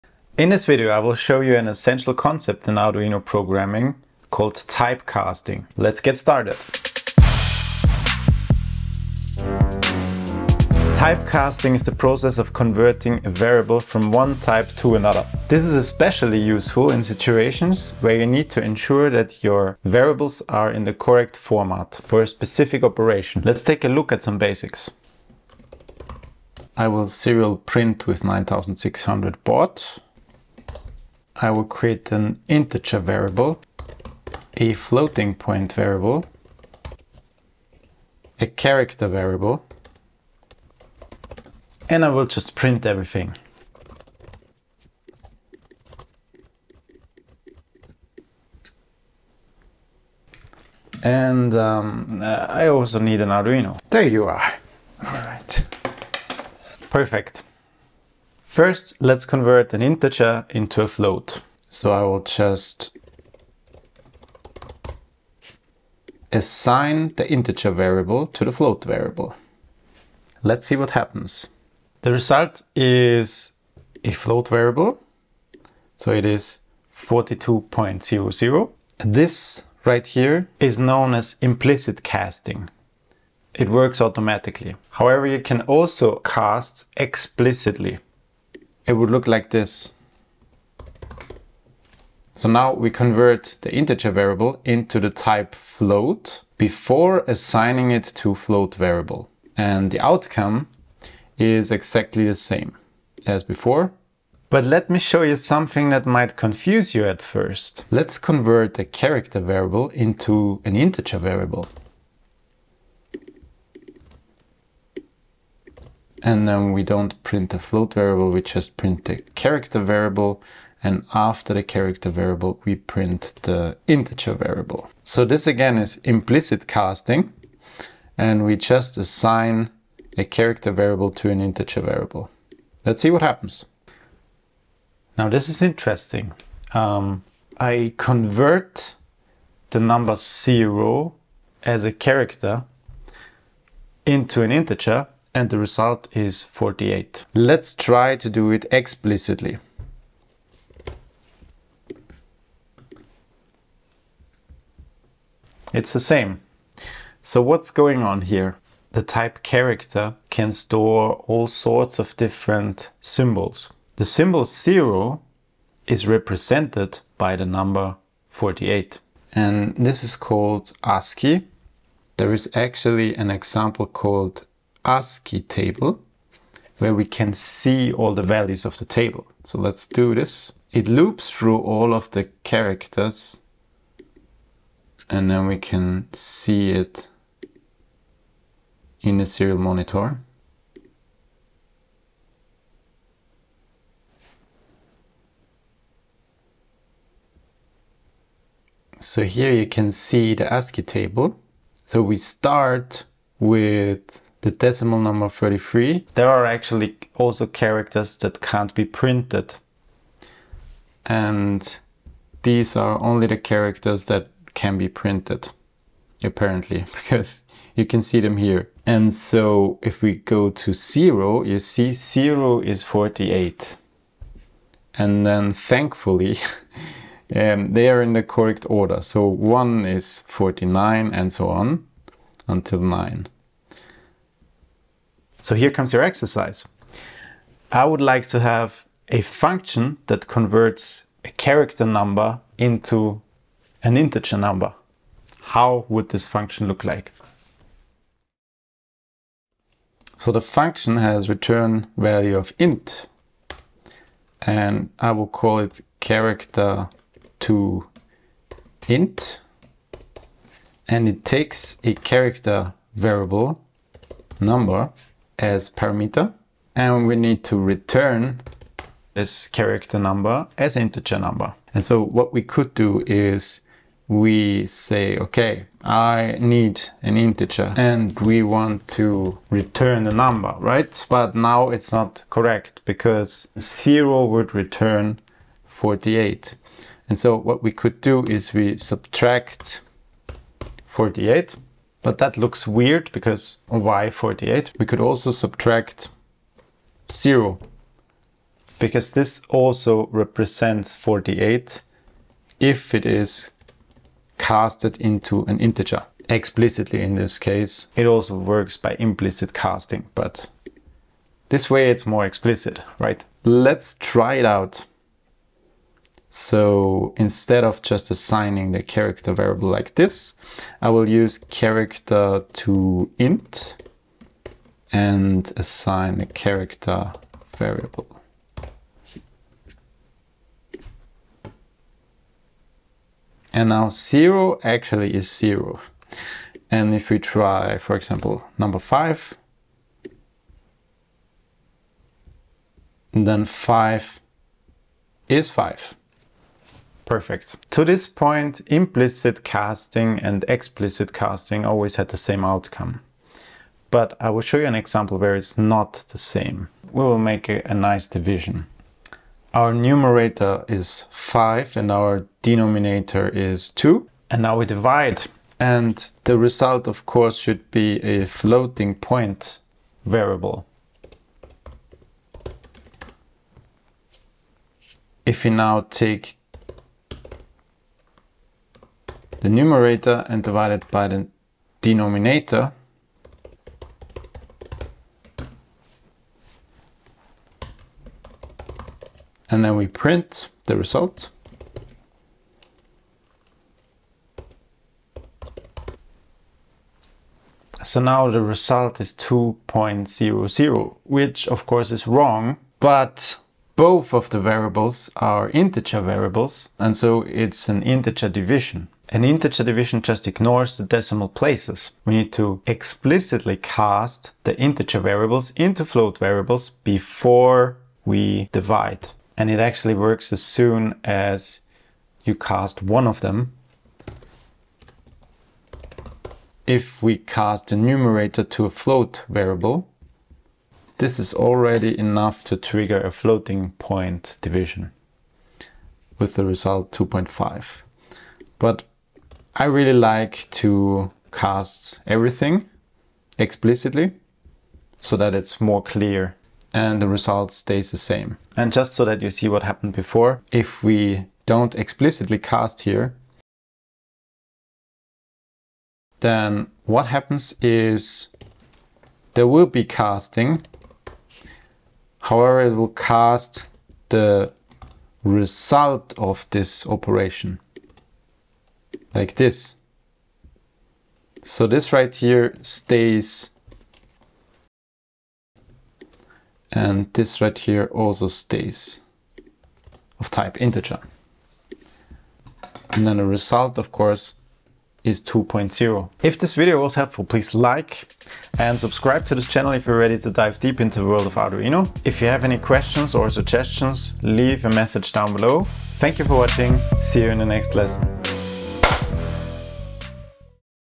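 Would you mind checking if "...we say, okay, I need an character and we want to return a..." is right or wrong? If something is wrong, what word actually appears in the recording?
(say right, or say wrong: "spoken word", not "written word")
wrong: "integer", not "character".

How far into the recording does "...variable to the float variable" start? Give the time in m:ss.
1:07.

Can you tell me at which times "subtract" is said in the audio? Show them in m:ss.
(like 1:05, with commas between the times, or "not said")
4:48, 4:55.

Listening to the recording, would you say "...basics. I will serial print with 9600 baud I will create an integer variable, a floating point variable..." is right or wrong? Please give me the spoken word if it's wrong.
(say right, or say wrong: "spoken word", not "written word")
right.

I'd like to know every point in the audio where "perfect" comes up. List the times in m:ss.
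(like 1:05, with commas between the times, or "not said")
0:56, 5:47.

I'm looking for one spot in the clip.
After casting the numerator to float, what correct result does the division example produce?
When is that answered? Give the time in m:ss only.
7:16.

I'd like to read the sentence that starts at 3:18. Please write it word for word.
So here you can see the ASCII table.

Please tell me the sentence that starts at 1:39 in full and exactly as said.
And the outcome is exactly the same as before.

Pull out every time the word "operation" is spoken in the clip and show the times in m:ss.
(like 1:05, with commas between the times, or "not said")
0:22, 7:46.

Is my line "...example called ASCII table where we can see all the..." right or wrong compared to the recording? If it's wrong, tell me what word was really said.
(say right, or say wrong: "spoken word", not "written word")
right.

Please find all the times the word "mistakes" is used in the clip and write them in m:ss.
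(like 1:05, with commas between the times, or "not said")
not said.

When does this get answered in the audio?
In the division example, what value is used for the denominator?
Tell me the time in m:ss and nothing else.
6:03.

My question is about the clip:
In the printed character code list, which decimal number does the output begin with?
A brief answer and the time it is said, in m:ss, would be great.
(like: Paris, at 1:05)
33, at 3:25.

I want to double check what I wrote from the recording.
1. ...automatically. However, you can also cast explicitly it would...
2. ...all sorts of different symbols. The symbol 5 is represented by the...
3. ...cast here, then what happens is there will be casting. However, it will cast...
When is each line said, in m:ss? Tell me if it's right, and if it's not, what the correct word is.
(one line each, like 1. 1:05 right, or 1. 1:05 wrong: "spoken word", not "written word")
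1. 1:24 right
2. 2:41 wrong: "0", not "5"
3. 7:32 right.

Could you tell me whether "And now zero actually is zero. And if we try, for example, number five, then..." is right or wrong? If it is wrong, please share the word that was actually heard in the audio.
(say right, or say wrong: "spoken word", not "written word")
right.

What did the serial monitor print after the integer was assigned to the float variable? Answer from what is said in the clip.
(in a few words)
42.00.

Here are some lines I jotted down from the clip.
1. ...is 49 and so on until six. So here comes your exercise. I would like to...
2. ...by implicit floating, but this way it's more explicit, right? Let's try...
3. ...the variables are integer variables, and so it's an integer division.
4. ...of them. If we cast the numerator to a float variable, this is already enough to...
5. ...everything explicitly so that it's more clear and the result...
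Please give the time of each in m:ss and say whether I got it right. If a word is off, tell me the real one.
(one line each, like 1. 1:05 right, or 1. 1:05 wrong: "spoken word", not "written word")
1. 3:49 wrong: "nine", not "six"
2. 5:08 wrong: "casting", not "floating"
3. 6:44 right
4. 7:03 right
5. 7:22 right.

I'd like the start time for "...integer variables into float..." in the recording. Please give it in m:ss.
6:54.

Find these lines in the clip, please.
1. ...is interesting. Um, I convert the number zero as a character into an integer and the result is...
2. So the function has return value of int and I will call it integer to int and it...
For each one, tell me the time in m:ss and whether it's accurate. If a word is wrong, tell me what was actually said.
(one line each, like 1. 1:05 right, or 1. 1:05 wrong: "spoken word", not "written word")
1. 2:15 right
2. 4:10 wrong: "character", not "integer".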